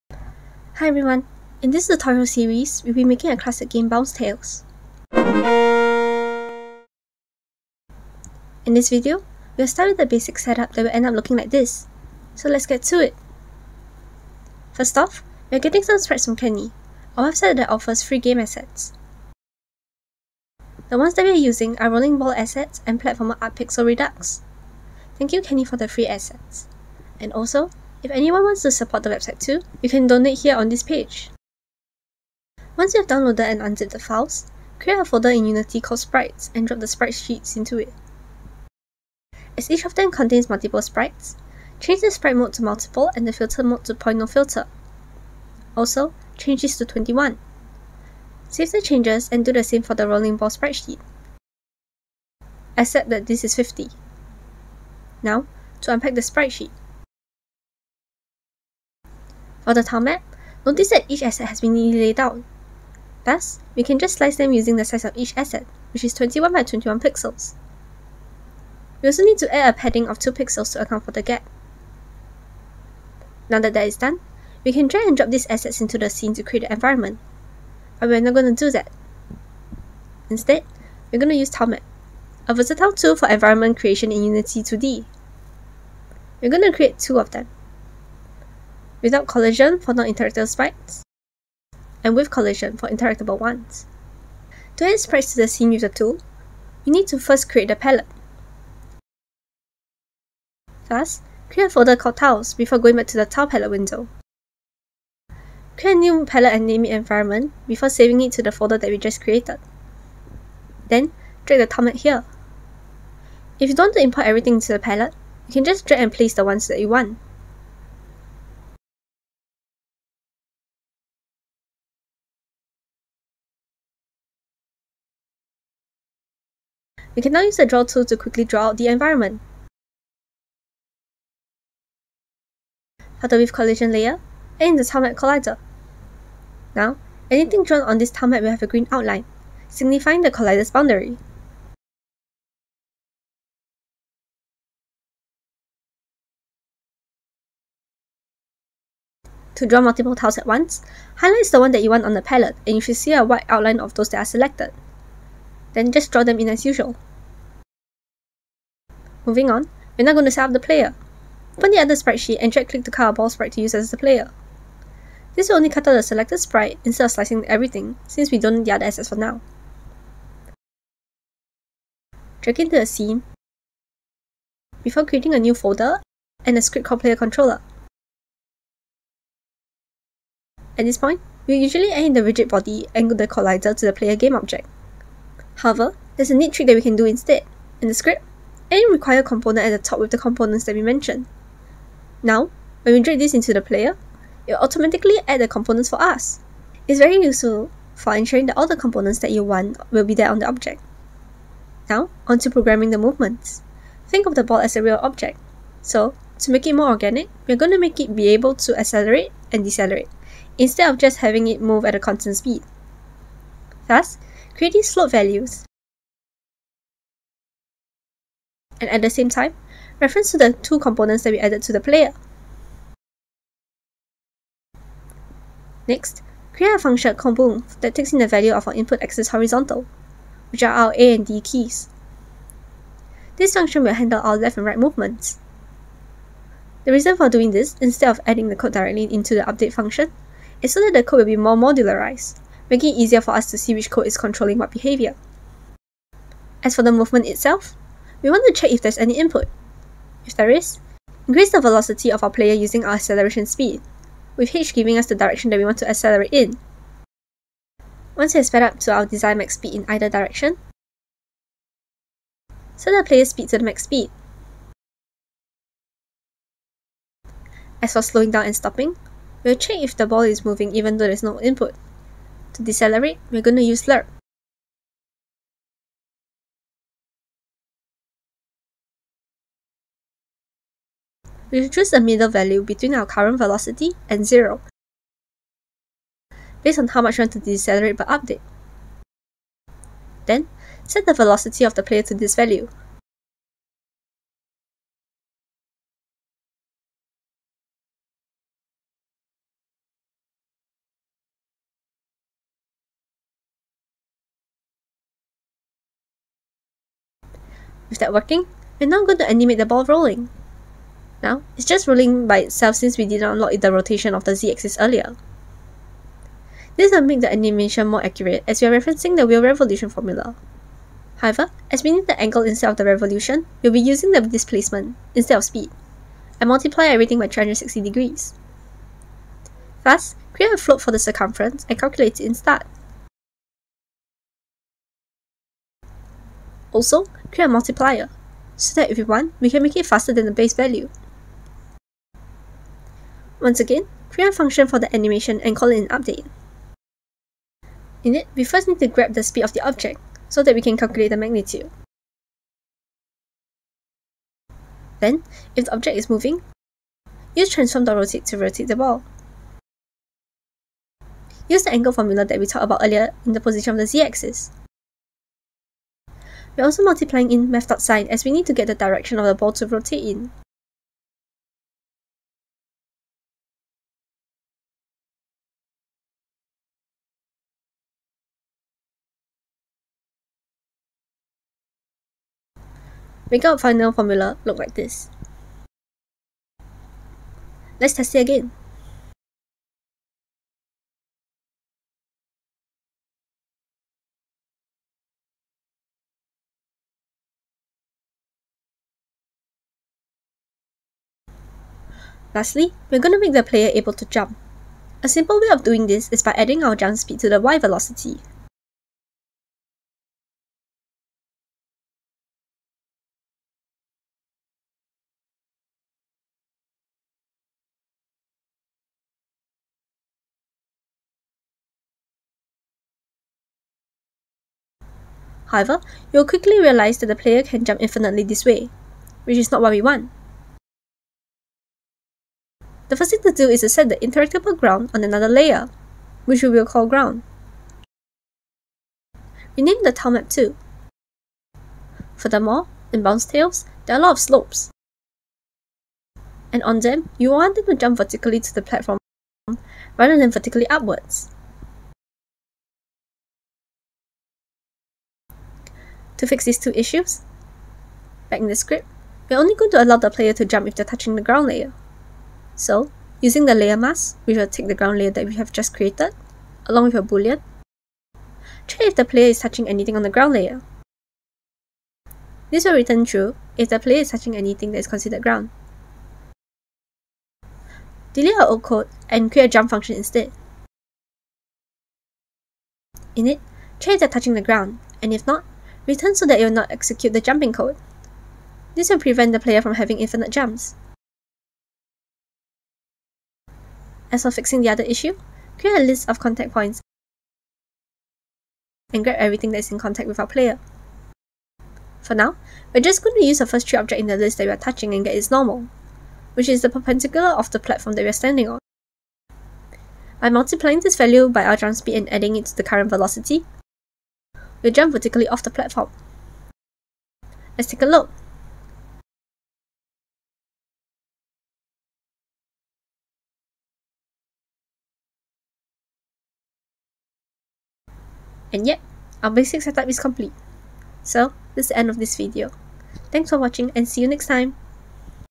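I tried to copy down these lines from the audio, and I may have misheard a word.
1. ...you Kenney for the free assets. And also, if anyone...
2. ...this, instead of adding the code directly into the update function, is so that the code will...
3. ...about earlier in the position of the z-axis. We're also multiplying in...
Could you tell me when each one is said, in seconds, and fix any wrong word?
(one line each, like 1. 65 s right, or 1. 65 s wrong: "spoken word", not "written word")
1. 25 s right
2. 237 s right
3. 362 s right.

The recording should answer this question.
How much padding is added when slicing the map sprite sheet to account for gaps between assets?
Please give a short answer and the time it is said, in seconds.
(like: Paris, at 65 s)
2 pixels, at 70 s.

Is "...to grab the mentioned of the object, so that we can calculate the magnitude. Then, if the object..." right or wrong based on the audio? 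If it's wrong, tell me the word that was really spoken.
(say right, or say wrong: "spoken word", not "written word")
wrong: "speed", not "mentioned".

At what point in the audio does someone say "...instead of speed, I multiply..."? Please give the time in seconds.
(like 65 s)
325 s.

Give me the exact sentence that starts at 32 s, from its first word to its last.
Once you have downloaded and unzipped the files, create a folder in Unity called Sprites and drop the sprite sheets into it.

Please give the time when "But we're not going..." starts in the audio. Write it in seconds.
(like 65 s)
77 s.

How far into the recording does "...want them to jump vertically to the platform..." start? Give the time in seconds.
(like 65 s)
447 s.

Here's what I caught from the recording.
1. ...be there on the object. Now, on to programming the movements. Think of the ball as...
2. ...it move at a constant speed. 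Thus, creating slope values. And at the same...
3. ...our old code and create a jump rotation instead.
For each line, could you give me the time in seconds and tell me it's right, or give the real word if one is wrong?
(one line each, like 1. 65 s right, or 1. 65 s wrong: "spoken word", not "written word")
1. 200 s right
2. 211 s right
3. 478 s wrong: "function", not "rotation".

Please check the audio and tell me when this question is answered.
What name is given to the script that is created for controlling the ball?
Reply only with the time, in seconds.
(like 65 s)
177 s.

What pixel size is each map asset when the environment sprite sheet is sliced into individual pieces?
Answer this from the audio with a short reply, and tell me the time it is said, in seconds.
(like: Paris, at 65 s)
21 by 21 pixels, at 66 s.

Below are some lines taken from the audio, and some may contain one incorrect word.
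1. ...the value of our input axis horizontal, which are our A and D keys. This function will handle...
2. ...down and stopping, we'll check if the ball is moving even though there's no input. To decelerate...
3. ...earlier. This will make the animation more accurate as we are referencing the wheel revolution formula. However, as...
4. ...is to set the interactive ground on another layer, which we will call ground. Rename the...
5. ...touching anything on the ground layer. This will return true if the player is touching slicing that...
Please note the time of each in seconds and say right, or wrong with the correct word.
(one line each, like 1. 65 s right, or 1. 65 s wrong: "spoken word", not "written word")
1. 228 s right
2. 268 s right
3. 314 s right
4. 433 s right
5. 469 s wrong: "anything", not "slicing".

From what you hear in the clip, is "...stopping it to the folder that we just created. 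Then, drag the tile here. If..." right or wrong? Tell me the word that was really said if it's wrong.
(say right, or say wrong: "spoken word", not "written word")
wrong: "saving", not "stopping".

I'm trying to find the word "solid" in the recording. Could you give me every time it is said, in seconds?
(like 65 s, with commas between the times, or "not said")
not said.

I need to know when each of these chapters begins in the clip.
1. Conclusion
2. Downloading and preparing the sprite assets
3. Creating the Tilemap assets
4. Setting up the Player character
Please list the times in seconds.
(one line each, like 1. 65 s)
1. 520 s
2. 14 s
3. 77 s
4. 158 s.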